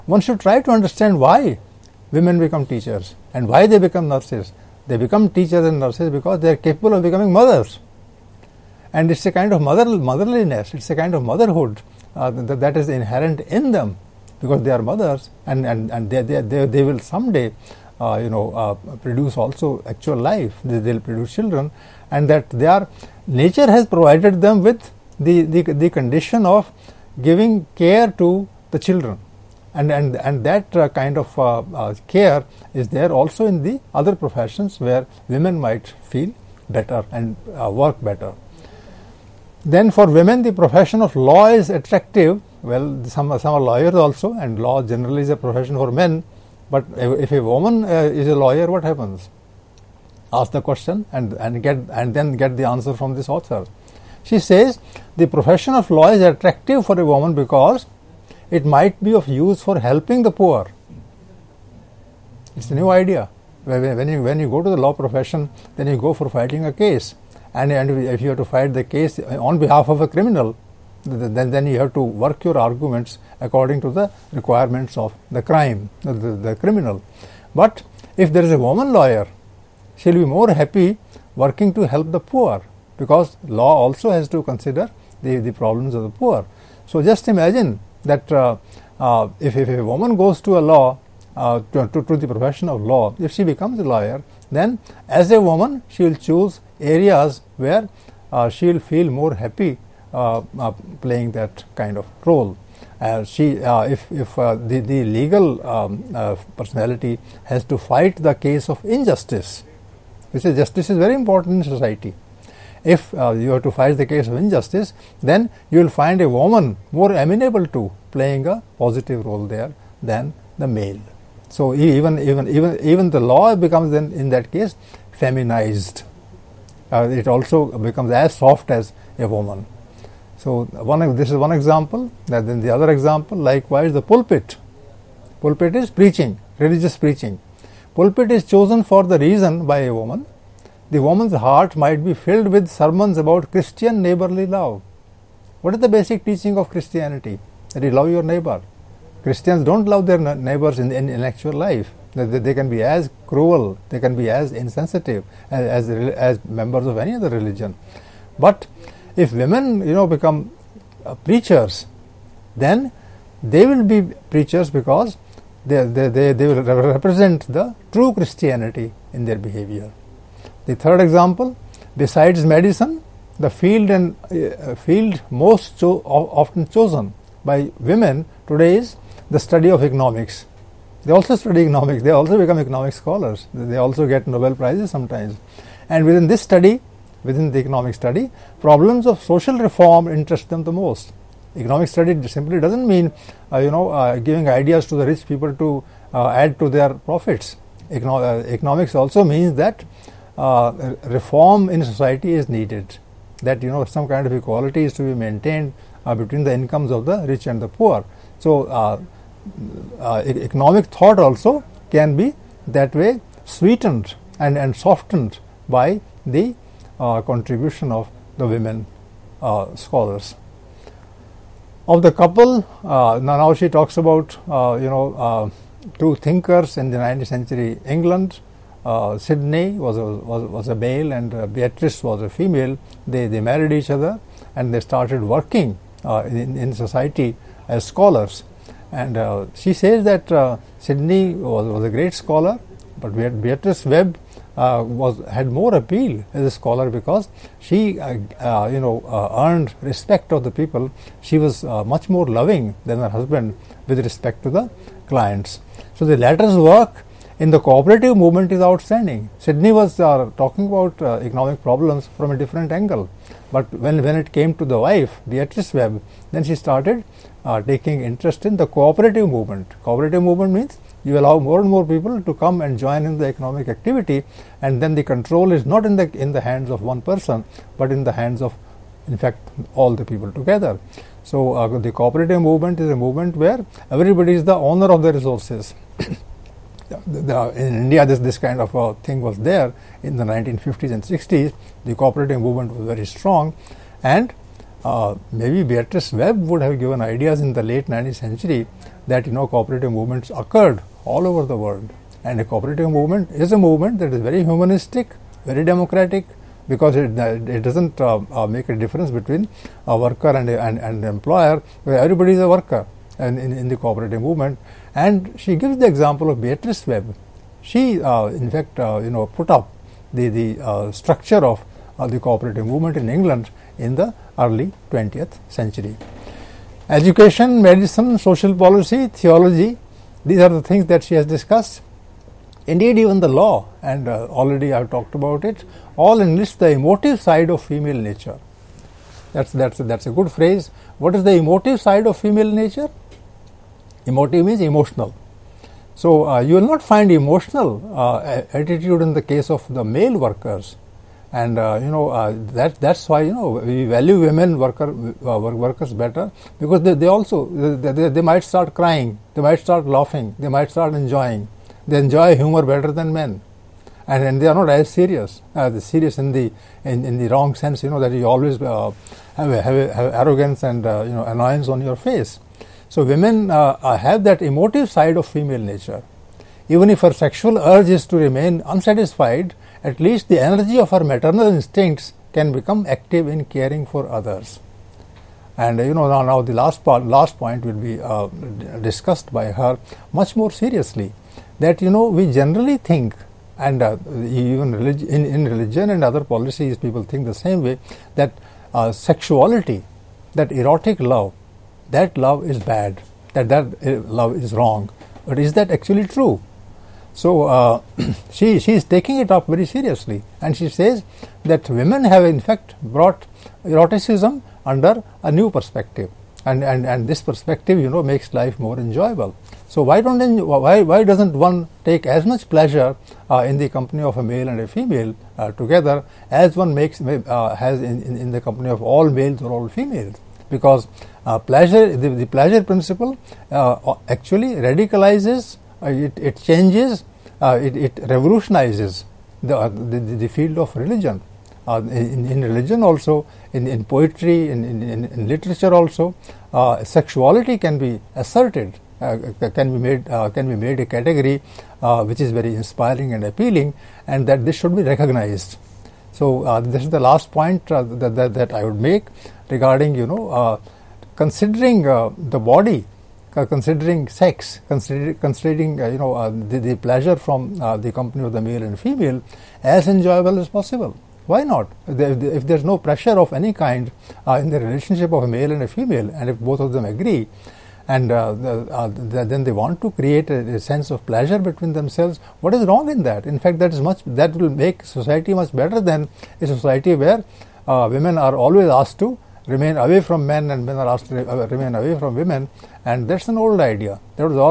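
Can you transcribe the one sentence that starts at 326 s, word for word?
Education, medicine, social policy, theology, these are the things that she has discussed.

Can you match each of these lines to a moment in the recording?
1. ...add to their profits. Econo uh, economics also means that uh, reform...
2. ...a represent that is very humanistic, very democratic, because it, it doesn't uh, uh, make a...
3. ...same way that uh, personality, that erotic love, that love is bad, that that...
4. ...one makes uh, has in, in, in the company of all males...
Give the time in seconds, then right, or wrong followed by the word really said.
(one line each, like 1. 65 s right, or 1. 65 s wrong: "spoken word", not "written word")
1. 196 s right
2. 303 s wrong: "movement", not "represent"
3. 397 s wrong: "sexuality", not "personality"
4. 426 s right.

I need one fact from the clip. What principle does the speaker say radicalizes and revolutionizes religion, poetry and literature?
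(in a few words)
pleasure principle.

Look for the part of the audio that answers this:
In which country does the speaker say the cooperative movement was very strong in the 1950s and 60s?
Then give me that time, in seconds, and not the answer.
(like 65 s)
287 s.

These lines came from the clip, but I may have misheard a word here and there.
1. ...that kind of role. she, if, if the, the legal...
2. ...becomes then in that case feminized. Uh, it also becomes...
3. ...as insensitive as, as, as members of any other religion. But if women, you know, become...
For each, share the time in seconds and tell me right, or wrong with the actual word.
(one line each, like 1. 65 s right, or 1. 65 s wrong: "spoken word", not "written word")
1. 101 s right
2. 123 s right
3. 154 s right.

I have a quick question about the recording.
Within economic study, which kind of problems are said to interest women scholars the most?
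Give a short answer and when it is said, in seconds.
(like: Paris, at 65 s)
social reform, at 189 s.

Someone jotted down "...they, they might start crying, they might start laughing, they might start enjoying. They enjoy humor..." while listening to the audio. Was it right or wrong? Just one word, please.
right.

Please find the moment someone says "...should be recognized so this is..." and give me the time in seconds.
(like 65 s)
454 s.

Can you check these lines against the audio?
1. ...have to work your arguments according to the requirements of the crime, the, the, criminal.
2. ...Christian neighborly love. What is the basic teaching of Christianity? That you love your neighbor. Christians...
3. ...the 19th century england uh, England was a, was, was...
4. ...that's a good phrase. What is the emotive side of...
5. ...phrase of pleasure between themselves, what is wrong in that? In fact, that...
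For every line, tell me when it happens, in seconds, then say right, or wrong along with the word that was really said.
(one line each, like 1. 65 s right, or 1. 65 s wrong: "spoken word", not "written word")
1. 71 s right
2. 143 s right
3. 226 s wrong: "Sidney", not "England"
4. 339 s right
5. 480 s wrong: "sense", not "phrase".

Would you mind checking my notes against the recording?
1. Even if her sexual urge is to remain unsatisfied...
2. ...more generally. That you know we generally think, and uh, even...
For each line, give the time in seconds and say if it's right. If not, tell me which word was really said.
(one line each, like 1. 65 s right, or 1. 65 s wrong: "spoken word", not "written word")
1. 376 s right
2. 390 s wrong: "seriously", not "generally".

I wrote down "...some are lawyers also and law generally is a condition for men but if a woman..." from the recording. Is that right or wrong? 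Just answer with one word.
wrong.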